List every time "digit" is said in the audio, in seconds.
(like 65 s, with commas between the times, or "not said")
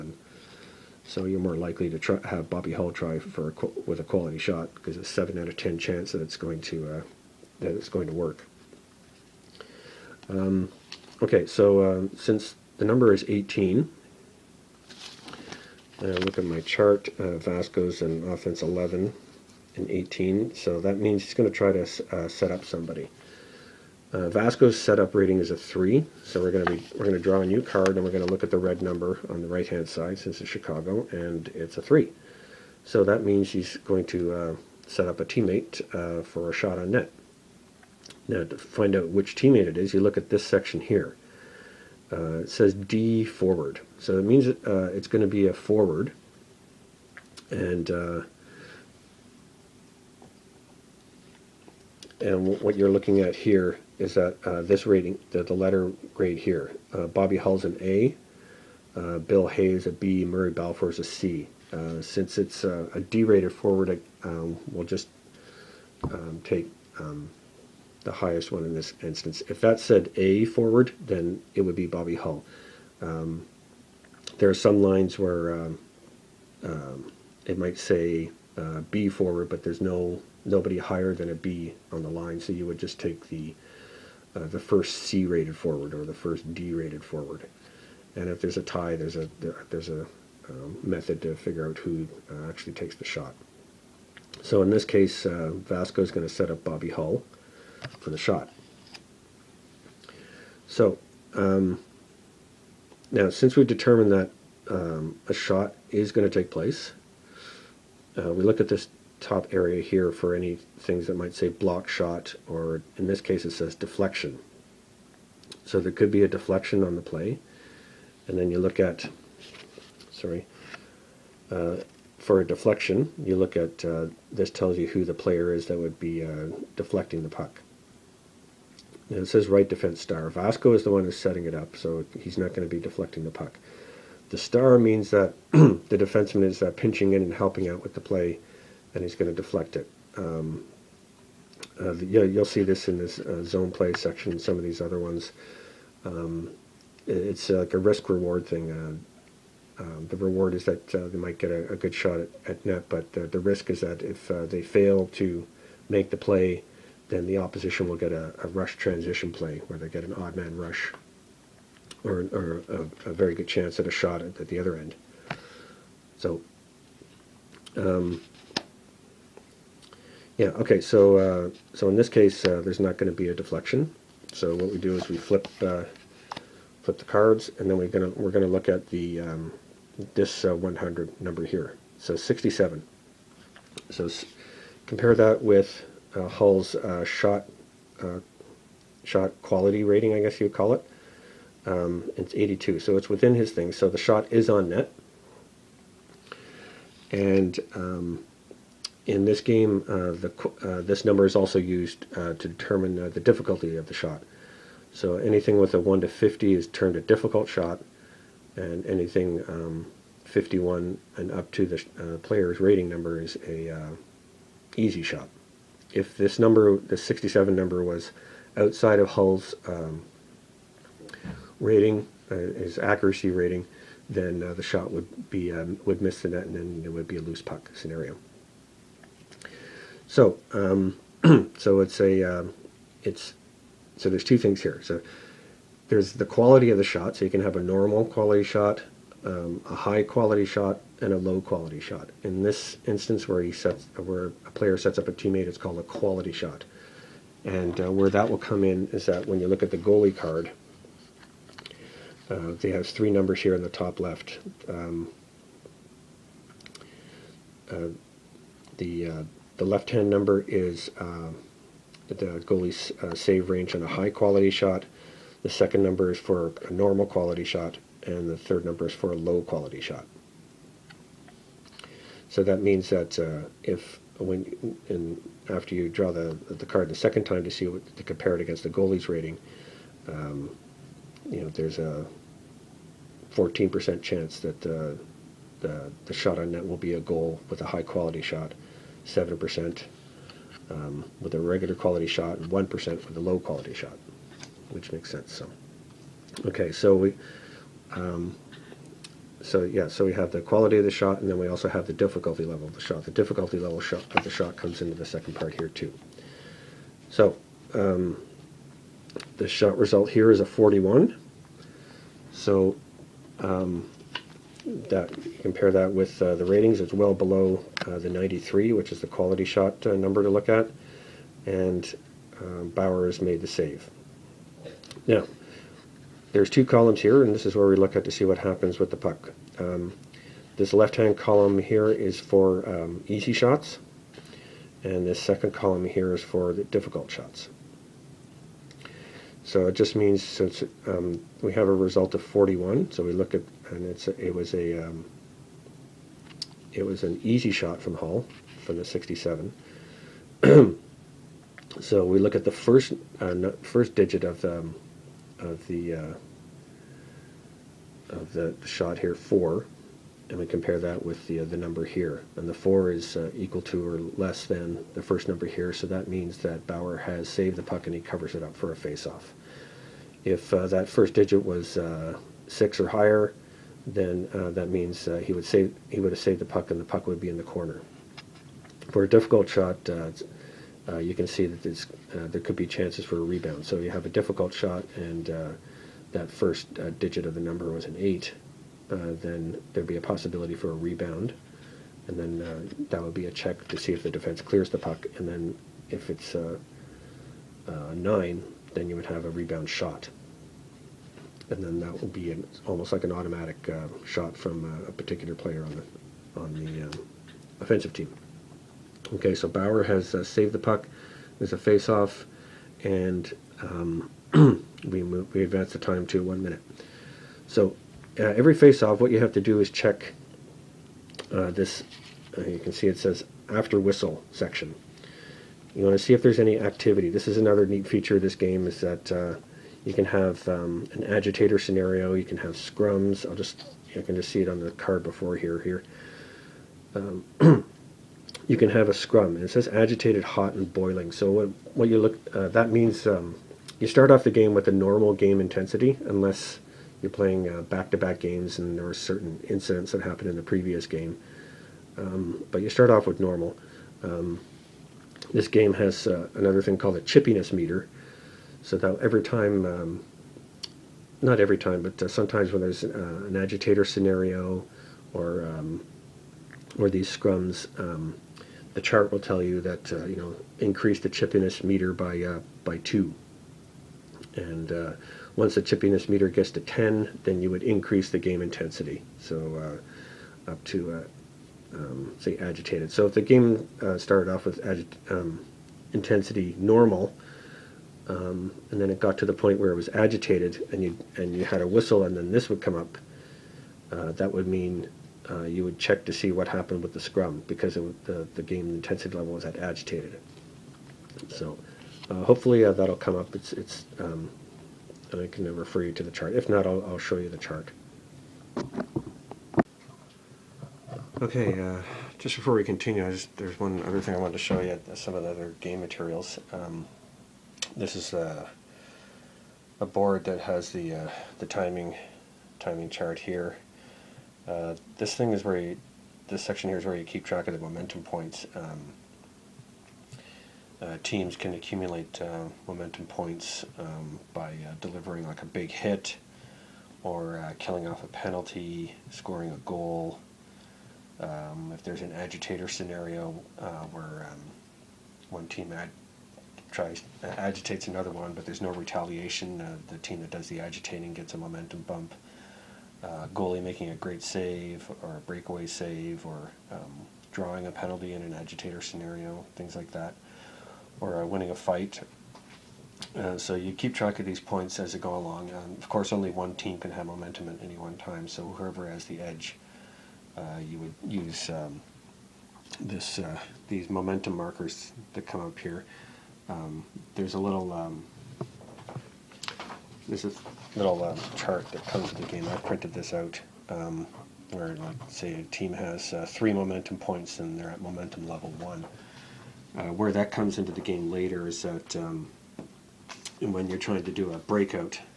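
353 s, 371 s, 386 s.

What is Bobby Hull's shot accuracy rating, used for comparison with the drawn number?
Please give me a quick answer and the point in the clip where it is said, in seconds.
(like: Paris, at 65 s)
82, at 192 s.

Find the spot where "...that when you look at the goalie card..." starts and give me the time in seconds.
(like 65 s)
249 s.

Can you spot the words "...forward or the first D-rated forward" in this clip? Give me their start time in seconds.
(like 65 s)
85 s.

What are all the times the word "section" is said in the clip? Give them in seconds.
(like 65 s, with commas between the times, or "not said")
40 s, 143 s, 424 s, 526 s.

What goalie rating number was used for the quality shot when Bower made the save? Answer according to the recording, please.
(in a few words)
93.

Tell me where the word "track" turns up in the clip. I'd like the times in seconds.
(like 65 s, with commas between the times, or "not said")
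527 s, 563 s.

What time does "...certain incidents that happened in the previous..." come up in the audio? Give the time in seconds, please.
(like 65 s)
448 s.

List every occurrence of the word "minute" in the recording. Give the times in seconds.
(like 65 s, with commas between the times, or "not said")
416 s.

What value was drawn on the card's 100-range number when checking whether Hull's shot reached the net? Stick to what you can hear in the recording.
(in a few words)
67.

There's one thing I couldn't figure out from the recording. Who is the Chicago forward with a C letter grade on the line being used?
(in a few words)
Murray Balfour.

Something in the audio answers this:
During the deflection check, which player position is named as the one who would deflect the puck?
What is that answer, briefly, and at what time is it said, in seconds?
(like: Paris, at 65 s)
Right defense star, at 129 s.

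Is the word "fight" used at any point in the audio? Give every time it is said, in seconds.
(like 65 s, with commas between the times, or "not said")
561 s.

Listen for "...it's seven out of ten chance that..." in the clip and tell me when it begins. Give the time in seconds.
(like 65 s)
4 s.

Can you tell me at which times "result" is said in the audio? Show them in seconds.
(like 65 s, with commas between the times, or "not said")
309 s, 341 s.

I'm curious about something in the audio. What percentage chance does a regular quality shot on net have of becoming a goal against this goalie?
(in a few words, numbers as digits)
7%.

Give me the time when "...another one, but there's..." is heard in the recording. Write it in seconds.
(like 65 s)
547 s.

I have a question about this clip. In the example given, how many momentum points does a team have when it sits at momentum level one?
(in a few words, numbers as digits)
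3.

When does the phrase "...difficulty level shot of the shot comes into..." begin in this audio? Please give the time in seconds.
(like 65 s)
303 s.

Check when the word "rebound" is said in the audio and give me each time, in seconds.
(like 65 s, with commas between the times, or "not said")
383 s, 390 s, 399 s.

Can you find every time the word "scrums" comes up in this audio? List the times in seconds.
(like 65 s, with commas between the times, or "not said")
432 s, 438 s, 467 s, 496 s.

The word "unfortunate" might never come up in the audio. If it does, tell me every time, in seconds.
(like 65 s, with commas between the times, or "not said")
not said.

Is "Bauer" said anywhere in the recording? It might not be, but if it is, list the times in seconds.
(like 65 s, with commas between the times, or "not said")
366 s, 409 s.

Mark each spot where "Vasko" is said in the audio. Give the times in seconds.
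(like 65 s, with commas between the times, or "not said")
17 s, 24 s, 95 s.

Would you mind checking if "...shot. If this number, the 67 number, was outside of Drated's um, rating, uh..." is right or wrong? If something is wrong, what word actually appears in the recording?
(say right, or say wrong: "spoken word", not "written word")
wrong: "Hull", not "Drated".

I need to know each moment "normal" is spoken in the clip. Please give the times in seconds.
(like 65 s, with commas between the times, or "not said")
237 s, 266 s, 444 s, 453 s, 486 s.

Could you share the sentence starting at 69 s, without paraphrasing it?
If that said A forward, then it would be Bobby Hull.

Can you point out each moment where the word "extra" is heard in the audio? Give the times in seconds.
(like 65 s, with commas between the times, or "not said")
not said.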